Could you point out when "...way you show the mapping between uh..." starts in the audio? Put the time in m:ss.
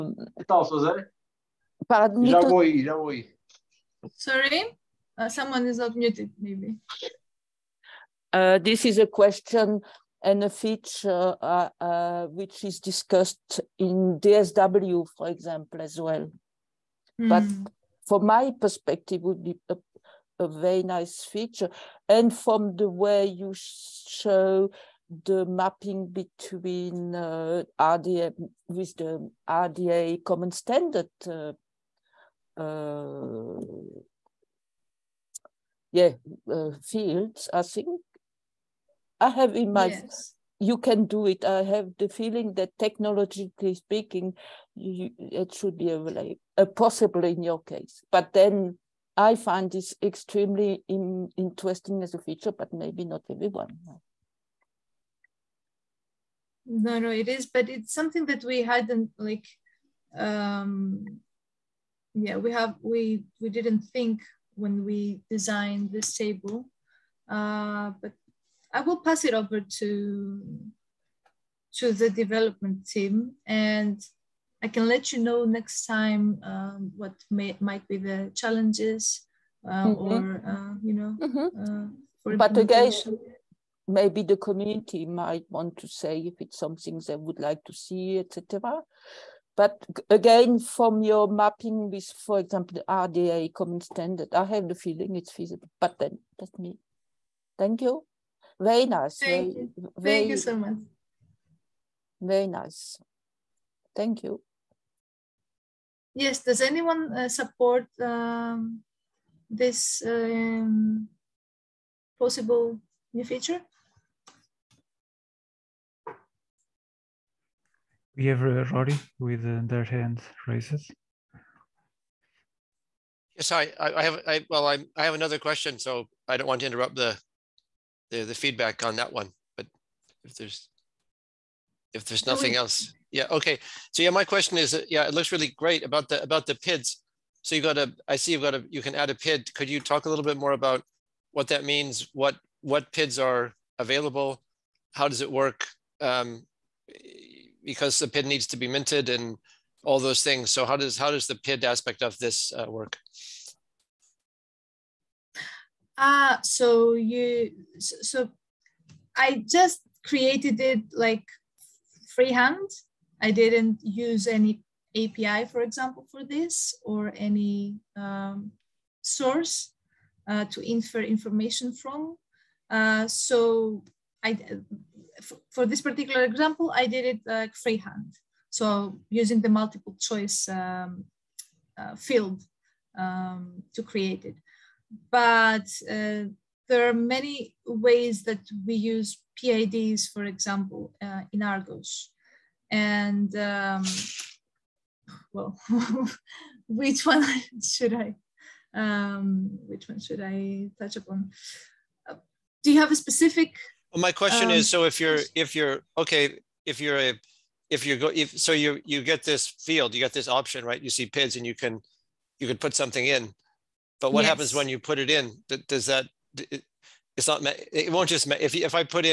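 0:22.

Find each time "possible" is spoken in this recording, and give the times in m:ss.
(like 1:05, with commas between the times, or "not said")
0:46, 1:52.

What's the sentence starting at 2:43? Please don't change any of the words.
I didn't use any API, for example, for this or any um, source uh, to infer information from.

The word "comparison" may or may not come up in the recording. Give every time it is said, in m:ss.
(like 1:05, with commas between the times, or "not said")
not said.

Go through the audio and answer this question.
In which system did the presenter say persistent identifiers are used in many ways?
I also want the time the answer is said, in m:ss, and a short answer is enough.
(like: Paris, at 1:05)
Argos, at 3:11.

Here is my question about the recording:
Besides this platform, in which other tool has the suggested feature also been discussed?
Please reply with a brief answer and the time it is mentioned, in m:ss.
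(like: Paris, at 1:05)
DSW, at 0:14.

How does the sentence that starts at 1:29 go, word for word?
But again, from your mapping with, for example, the RDA common standard, I have the feeling it's feasible, but then that's me.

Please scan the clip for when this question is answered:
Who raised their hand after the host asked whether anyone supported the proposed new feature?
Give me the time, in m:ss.
1:58.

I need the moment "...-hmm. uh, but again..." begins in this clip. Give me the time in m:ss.
1:21.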